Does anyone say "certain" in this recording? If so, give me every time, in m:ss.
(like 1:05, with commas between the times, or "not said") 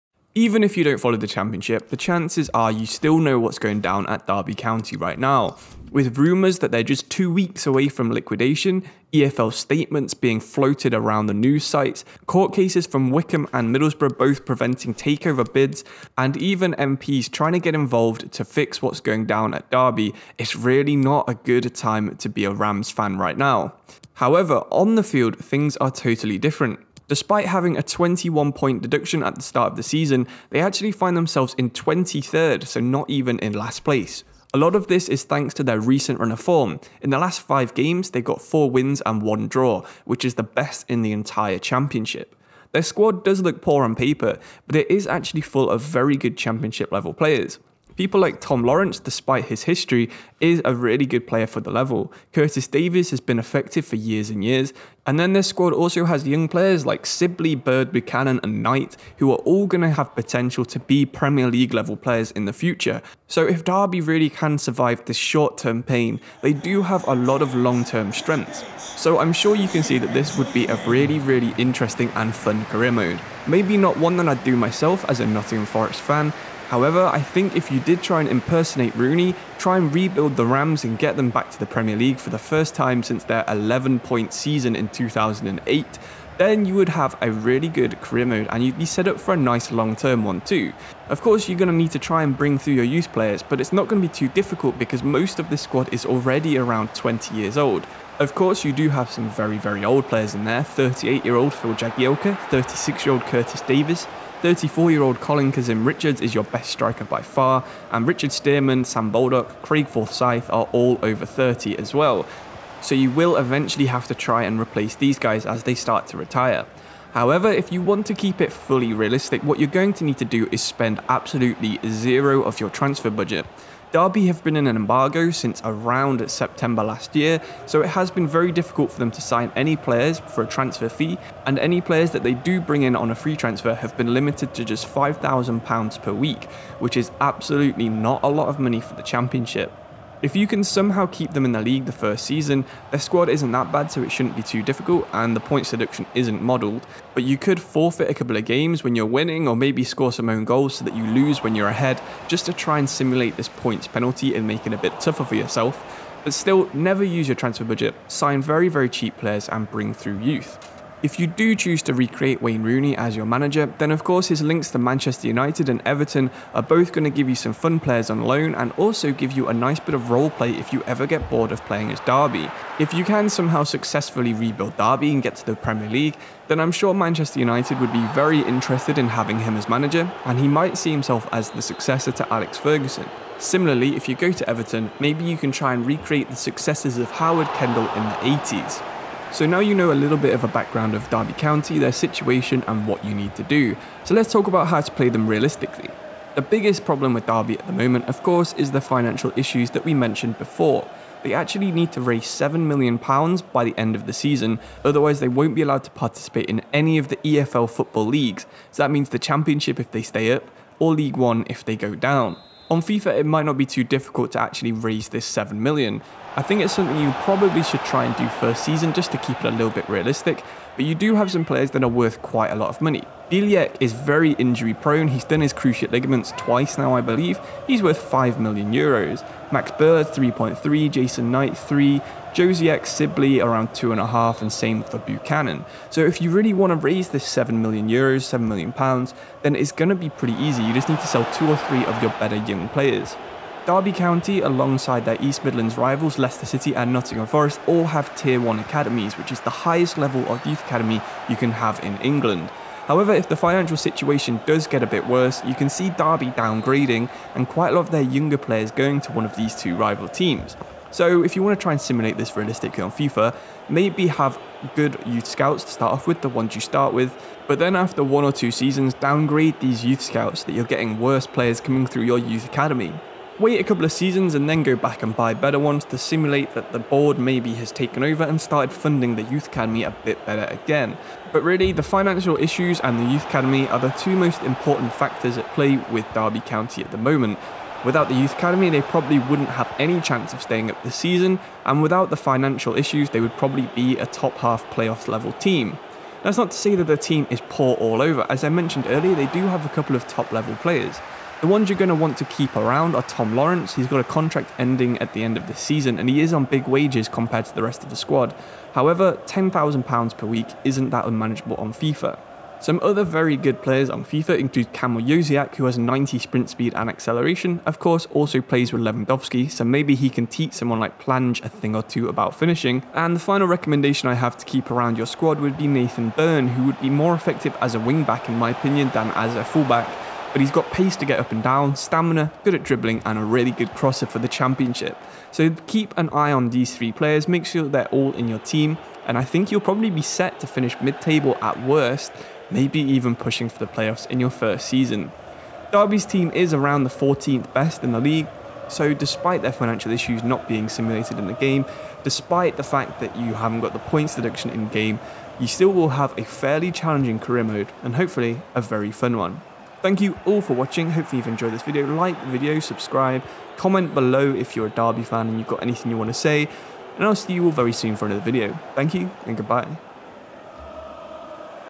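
not said.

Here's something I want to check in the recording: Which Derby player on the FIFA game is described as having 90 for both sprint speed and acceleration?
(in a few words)
Kamil Jóźwiak.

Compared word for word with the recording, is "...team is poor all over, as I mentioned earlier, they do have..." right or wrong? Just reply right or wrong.
right.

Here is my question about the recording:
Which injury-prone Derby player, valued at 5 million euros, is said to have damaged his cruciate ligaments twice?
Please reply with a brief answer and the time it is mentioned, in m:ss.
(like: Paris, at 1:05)
Bielik, at 3:43.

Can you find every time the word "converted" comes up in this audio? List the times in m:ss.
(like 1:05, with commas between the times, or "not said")
not said.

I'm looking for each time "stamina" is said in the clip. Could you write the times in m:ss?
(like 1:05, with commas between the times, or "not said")
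5:31.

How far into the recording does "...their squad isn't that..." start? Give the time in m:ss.
2:22.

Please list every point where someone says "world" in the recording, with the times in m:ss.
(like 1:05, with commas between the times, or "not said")
not said.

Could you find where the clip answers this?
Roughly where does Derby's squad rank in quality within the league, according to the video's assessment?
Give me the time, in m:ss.
5:46.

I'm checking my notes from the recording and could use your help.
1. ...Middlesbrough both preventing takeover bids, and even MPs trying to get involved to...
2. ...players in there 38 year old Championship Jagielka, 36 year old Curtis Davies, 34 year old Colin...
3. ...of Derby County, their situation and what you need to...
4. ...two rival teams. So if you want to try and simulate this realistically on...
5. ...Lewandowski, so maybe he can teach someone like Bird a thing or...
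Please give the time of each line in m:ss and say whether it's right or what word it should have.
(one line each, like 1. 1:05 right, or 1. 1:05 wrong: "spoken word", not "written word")
1. 0:13 right
2. 1:40 wrong: "Phil", not "Championship"
3. 3:10 right
4. 4:19 right
5. 5:18 wrong: "Plange", not "Bird".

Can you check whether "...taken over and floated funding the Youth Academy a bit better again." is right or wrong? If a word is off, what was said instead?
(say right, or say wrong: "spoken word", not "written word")
wrong: "started", not "floated".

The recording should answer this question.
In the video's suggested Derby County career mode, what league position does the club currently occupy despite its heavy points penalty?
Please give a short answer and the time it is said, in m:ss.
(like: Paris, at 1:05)
23rd, at 0:31.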